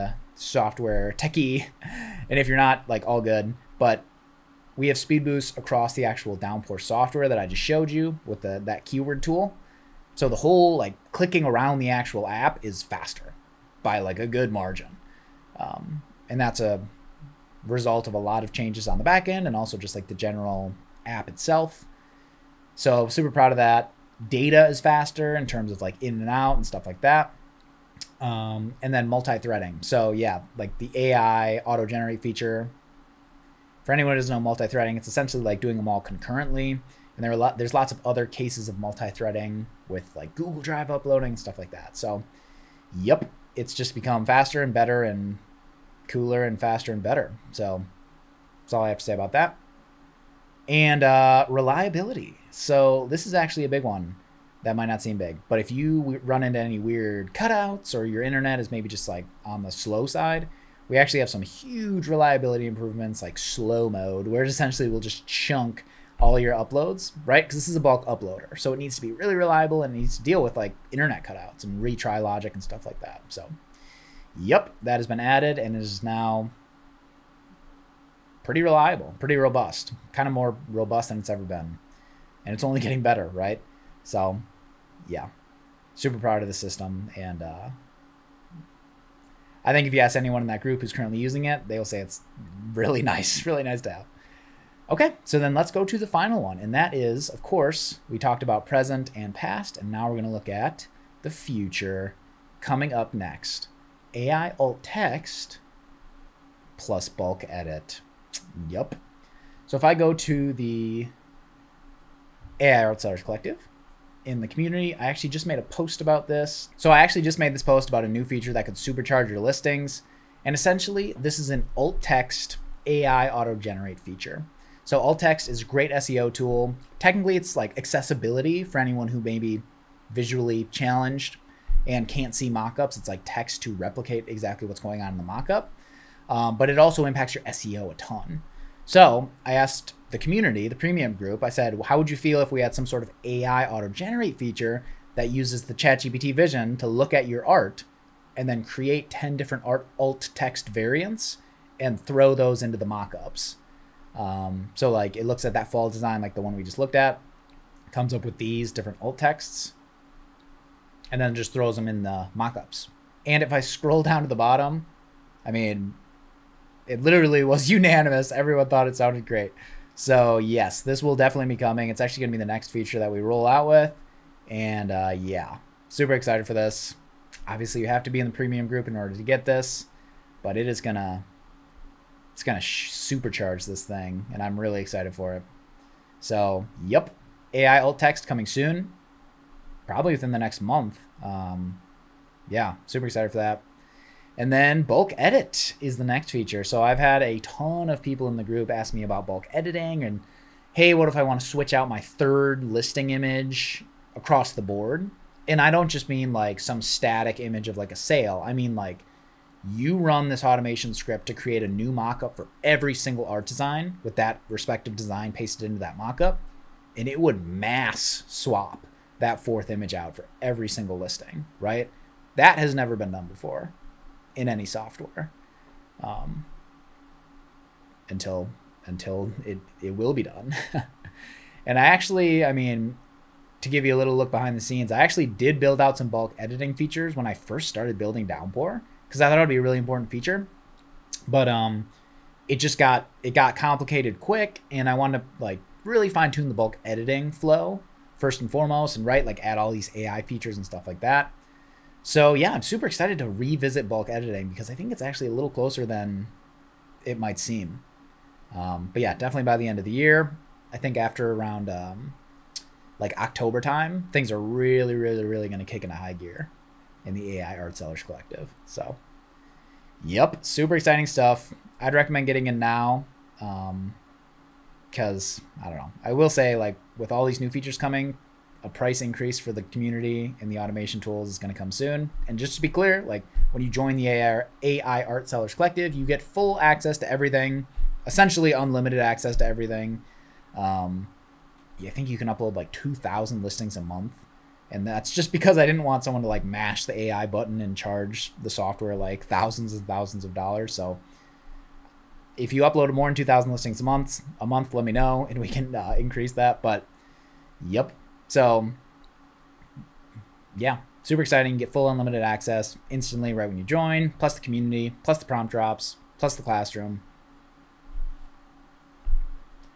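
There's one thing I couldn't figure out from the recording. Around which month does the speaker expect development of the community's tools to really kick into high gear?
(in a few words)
October.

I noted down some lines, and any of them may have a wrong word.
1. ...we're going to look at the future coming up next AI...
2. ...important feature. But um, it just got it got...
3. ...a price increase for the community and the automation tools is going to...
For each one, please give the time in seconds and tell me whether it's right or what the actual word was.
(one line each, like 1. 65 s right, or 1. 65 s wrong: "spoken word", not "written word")
1. 100 s right
2. 239 s right
3. 278 s right.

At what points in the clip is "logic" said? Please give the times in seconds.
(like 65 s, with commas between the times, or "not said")
72 s.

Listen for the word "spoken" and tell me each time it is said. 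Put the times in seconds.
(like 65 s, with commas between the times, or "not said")
not said.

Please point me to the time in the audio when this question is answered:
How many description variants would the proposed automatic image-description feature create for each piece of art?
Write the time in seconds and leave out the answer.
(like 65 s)
149 s.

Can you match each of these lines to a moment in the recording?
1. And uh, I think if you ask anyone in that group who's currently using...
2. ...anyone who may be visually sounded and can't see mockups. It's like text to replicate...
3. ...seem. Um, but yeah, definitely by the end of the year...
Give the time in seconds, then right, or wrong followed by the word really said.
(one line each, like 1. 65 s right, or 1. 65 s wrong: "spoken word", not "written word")
1. 87 s right
2. 128 s wrong: "challenged", not "sounded"
3. 257 s right.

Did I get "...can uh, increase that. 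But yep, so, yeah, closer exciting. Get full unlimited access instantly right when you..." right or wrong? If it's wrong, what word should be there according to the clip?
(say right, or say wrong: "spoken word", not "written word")
wrong: "super", not "closer".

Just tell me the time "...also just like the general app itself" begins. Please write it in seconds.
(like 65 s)
19 s.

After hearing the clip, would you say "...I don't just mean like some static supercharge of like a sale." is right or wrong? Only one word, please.
wrong.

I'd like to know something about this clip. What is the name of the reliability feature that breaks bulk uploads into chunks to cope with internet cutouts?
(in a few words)
slow mode.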